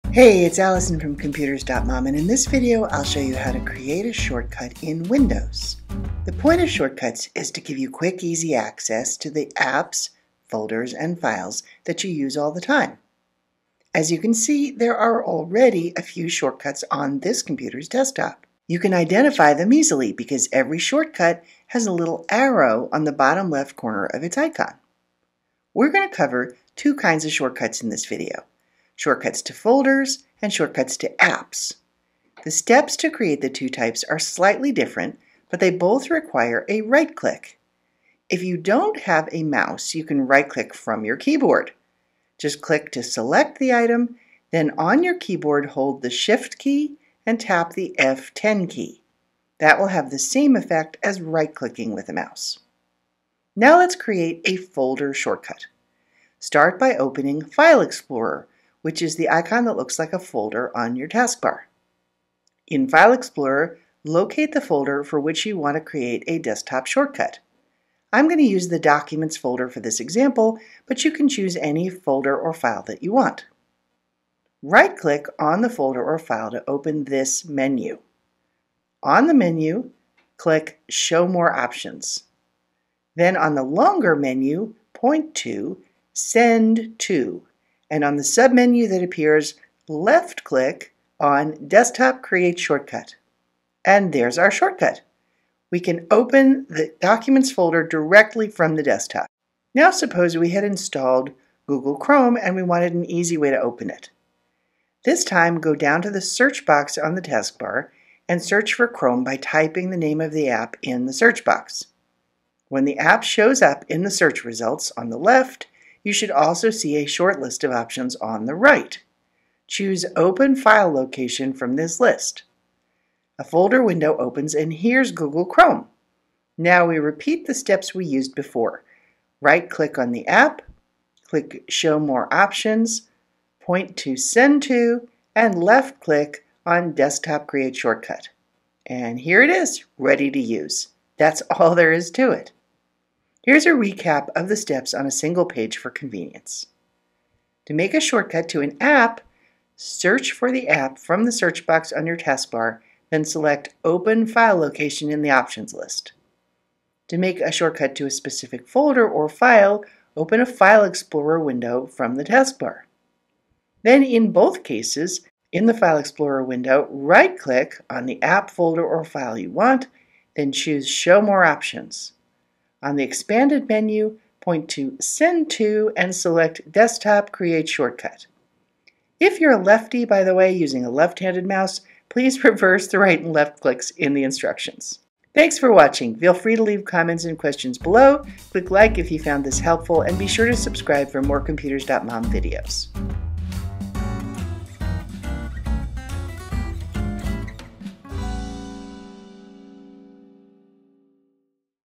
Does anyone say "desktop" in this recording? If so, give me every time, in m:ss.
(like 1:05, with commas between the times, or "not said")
0:17, 1:06, 1:31, 1:38, 2:16, 2:56.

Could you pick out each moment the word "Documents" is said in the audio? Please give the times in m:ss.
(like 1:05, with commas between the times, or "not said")
1:08, 1:37.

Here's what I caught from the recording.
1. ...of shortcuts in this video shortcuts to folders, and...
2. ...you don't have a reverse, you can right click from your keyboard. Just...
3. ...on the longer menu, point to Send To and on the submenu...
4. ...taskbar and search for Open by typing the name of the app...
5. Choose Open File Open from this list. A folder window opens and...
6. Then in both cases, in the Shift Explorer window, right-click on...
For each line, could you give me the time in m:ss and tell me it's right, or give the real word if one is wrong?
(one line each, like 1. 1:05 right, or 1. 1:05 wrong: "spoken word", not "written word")
1. 0:27 right
2. 0:38 wrong: "mouse", not "reverse"
3. 1:23 right
4. 1:47 wrong: "Chrome", not "Open"
5. 1:59 wrong: "Location", not "Open"
6. 2:43 wrong: "File", not "Shift".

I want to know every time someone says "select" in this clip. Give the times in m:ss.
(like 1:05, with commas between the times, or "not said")
0:43, 2:33, 2:56.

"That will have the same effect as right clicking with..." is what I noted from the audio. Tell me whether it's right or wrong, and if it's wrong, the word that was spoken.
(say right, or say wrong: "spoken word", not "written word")
right.